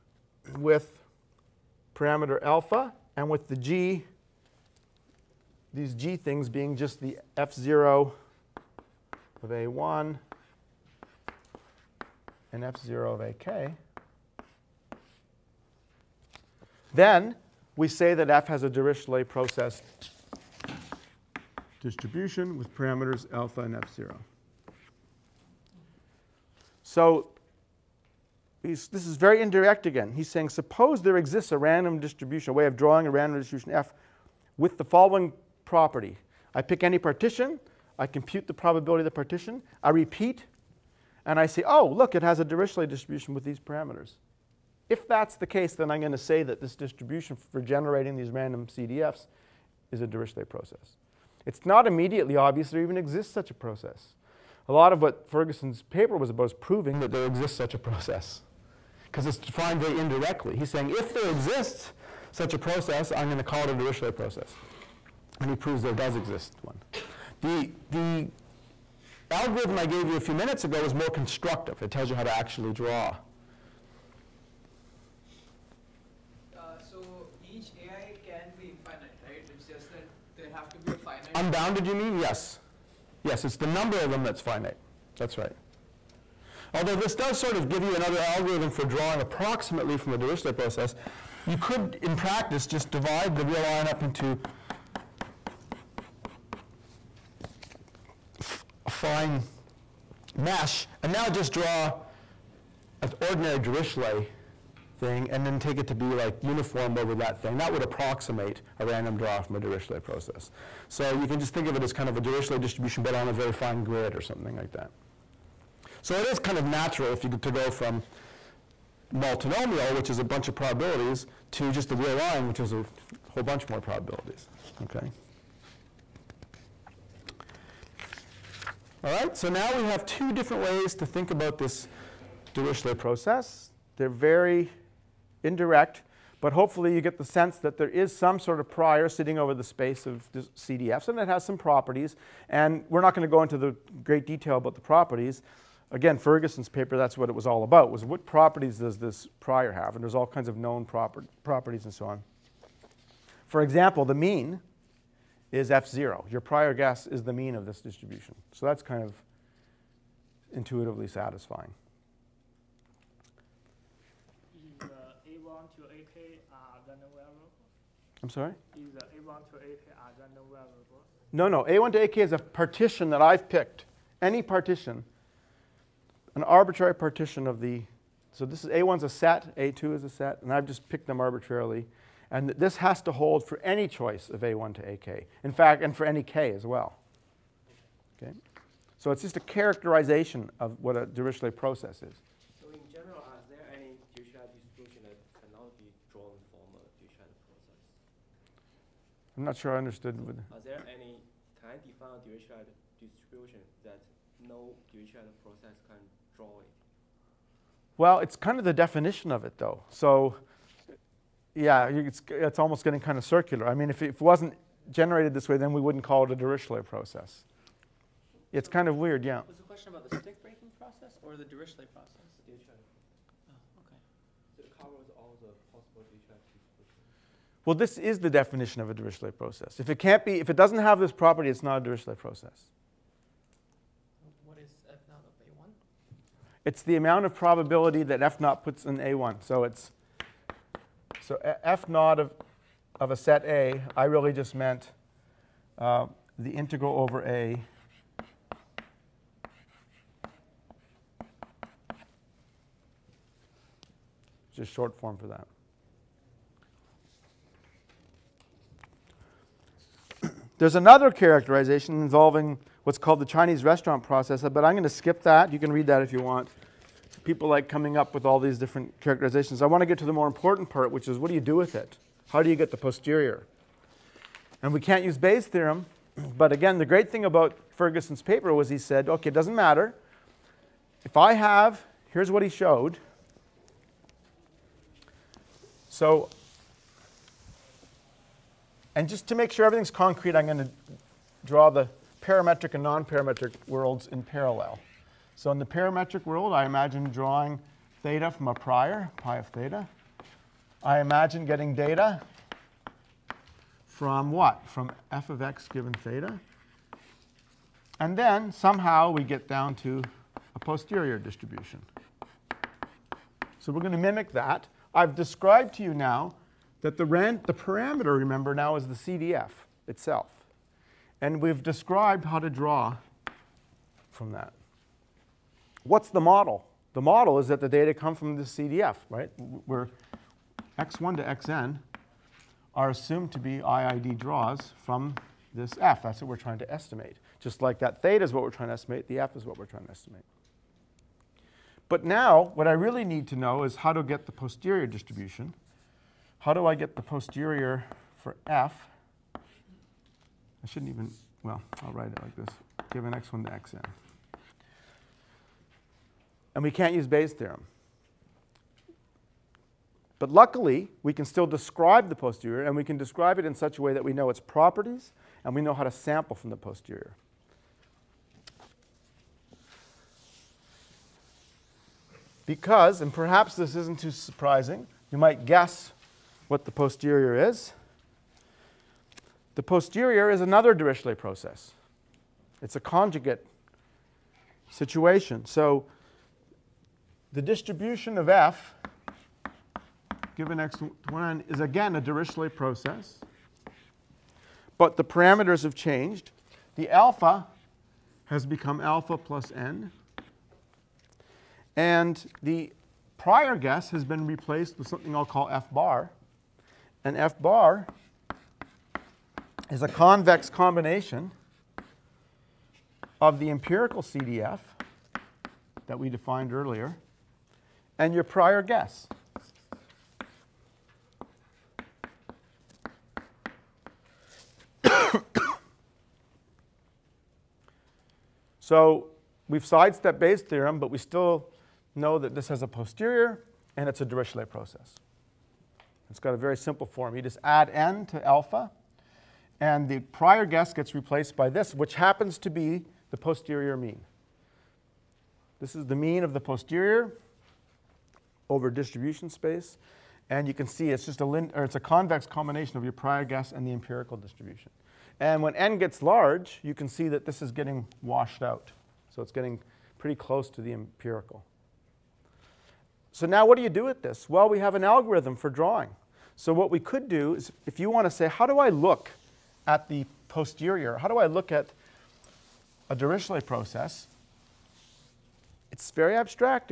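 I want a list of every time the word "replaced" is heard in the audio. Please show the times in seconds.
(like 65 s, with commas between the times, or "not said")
404 s, 440 s.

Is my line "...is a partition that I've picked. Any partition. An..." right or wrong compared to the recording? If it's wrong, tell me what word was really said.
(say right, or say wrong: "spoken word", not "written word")
right.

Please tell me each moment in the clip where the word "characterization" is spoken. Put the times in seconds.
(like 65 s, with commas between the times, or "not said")
189 s, 261 s, 269 s.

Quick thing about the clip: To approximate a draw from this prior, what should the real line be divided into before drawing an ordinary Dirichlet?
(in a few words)
fine mesh.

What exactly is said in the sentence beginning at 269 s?
I want to get to the more important part, which is what do you do with it?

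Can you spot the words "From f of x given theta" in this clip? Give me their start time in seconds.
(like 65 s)
304 s.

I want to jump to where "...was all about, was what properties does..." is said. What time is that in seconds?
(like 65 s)
147 s.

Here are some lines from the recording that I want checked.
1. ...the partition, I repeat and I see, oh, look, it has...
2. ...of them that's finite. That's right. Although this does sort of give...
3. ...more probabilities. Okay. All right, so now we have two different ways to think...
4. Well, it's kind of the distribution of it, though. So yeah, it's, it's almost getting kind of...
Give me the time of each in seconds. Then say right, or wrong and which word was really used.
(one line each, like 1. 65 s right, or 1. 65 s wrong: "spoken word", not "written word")
1. 39 s right
2. 83 s right
3. 123 s right
4. 207 s wrong: "definition", not "distribution".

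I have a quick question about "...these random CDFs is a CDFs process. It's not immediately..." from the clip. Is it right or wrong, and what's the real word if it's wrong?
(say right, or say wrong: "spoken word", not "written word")
wrong: "Dirichlet", not "CDFs".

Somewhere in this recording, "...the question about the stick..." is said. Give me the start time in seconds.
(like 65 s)
219 s.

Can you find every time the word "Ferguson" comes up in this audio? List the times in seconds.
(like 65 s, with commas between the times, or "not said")
55 s, 146 s, 277 s.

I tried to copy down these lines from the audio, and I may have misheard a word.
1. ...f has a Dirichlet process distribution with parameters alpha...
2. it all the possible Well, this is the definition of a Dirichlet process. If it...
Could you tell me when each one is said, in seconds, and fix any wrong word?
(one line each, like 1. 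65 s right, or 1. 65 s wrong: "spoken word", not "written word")
1. 18 s right
2. 224 s right.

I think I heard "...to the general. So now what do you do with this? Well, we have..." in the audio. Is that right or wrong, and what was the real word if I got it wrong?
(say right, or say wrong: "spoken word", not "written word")
wrong: "empirical", not "general".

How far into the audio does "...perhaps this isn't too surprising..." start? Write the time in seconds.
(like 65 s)
373 s.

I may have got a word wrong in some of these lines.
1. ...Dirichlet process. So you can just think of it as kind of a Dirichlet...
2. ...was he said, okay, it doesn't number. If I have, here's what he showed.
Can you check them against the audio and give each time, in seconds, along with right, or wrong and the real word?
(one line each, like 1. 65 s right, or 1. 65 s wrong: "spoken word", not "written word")
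1. 109 s right
2. 278 s wrong: "matter", not "number".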